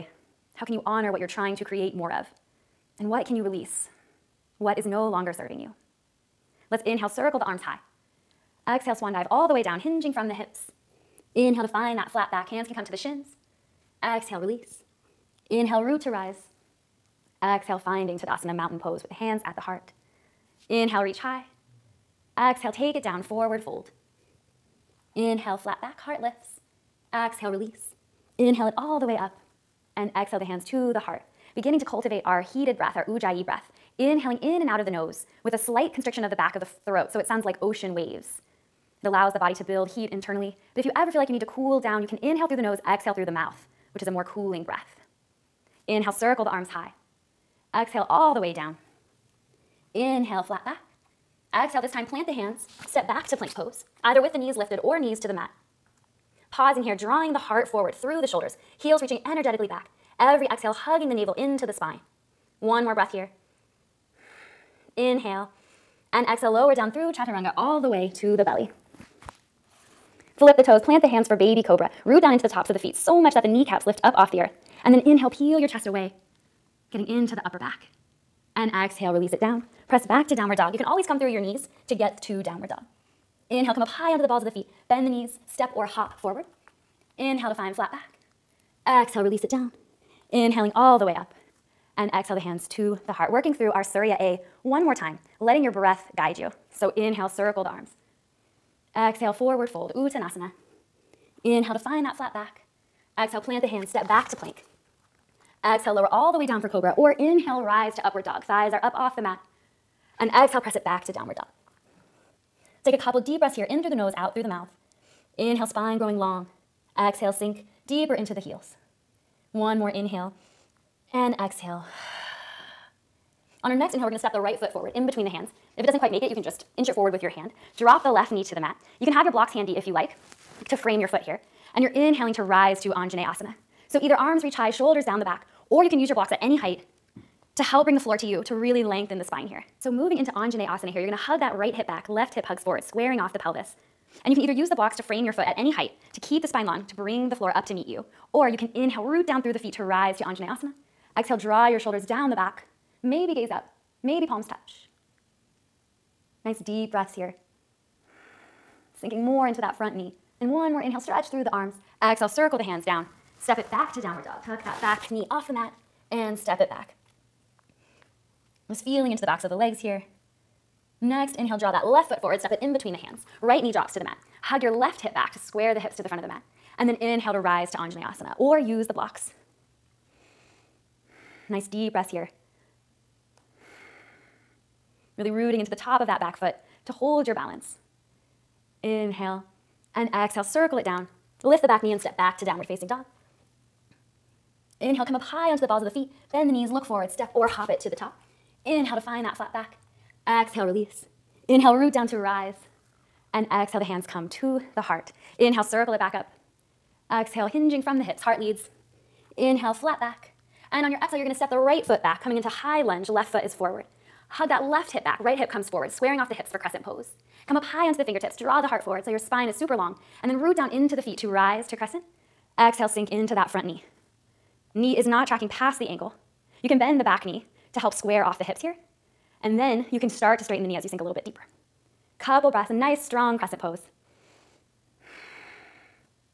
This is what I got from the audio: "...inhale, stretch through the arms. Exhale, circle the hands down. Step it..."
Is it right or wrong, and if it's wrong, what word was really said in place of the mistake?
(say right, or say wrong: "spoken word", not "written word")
right.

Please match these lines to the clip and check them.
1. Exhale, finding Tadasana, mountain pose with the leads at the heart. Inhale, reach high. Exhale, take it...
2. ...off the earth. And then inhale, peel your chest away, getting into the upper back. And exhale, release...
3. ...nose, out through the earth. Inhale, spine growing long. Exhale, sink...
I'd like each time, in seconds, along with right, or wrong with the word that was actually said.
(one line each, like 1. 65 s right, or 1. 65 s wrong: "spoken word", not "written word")
1. 17 s wrong: "hands", not "leads"
2. 74 s right
3. 113 s wrong: "mouth", not "earth".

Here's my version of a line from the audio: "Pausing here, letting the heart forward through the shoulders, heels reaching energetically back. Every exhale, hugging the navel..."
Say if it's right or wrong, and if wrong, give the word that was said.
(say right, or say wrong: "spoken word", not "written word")
wrong: "drawing", not "letting".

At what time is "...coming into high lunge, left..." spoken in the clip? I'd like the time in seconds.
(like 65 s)
212 s.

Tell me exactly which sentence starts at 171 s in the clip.
Next, inhale, draw that left foot forward, step it in between the hands.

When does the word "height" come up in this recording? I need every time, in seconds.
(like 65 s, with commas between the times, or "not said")
136 s, 145 s.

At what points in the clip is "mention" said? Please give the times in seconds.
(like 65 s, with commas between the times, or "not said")
not said.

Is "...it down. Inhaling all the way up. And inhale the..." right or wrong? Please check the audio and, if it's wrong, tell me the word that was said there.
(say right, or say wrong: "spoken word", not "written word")
wrong: "exhale", not "inhale".